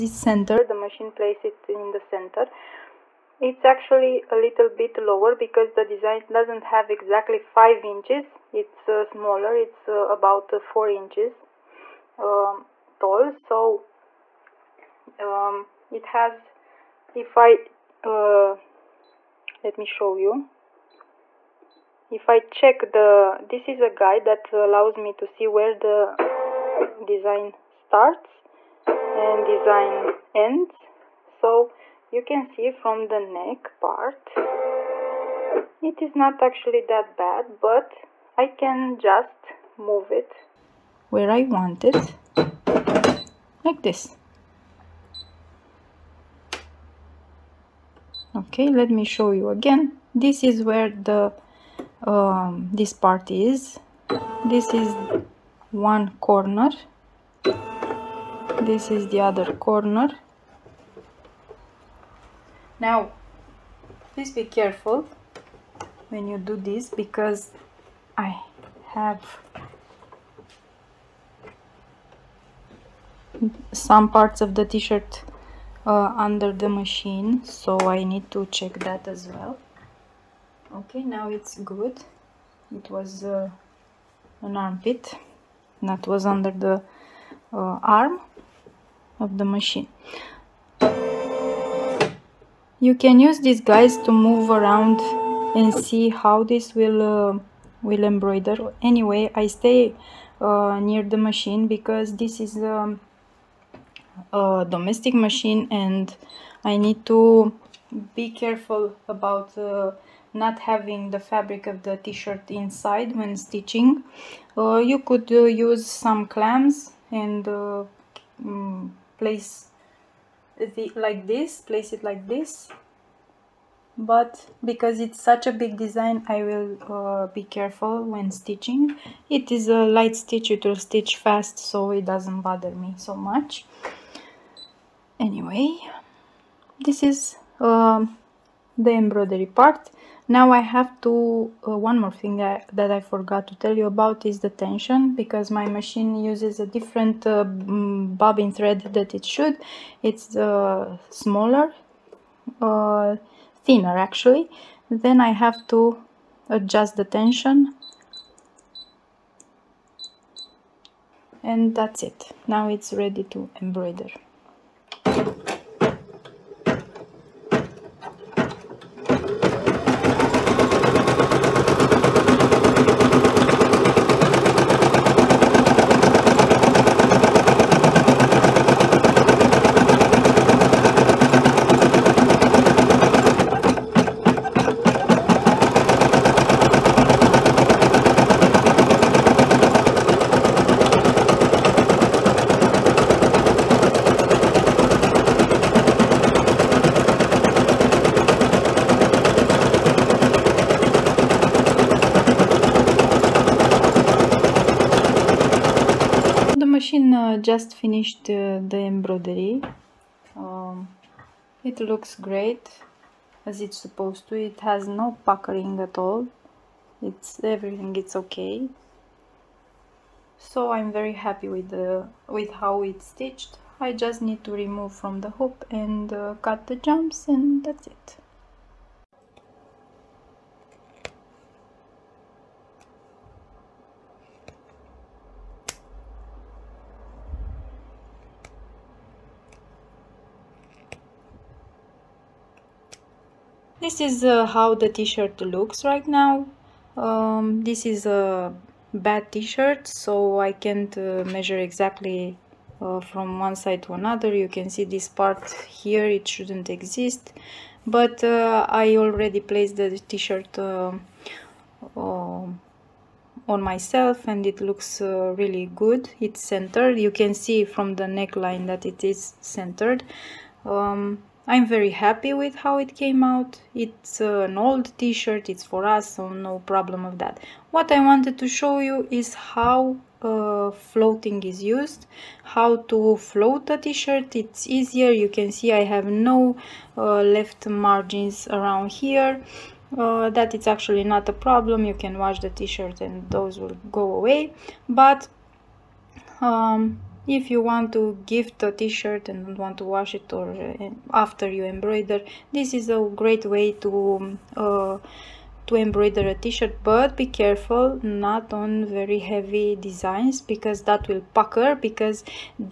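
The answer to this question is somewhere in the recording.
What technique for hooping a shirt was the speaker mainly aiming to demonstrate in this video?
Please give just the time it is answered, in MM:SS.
04:40.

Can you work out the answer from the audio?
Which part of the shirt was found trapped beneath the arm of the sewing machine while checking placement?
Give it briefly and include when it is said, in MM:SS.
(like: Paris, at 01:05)
an armpit, at 01:24.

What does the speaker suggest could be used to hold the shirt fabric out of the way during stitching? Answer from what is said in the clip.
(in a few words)
clamps.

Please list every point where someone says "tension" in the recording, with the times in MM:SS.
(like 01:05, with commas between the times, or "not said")
02:24, 02:37.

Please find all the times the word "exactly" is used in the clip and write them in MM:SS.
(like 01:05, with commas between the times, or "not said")
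00:06, 04:11.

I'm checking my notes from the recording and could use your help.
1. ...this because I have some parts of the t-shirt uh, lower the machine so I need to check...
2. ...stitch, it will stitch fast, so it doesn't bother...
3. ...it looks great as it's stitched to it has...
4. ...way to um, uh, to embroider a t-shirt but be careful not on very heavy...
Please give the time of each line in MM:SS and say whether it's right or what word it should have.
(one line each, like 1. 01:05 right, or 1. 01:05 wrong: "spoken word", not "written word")
1. 01:06 wrong: "under", not "lower"
2. 02:10 right
3. 03:31 wrong: "supposed", not "stitched"
4. 05:03 right.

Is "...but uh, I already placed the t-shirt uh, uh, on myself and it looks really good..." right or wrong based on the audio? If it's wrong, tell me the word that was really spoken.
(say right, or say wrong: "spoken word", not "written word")
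right.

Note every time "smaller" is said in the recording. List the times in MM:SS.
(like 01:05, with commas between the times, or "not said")
00:09, 02:31.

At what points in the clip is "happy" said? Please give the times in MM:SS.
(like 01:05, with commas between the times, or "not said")
03:41, 04:31.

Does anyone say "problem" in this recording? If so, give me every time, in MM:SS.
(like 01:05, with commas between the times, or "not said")
04:36, 04:51.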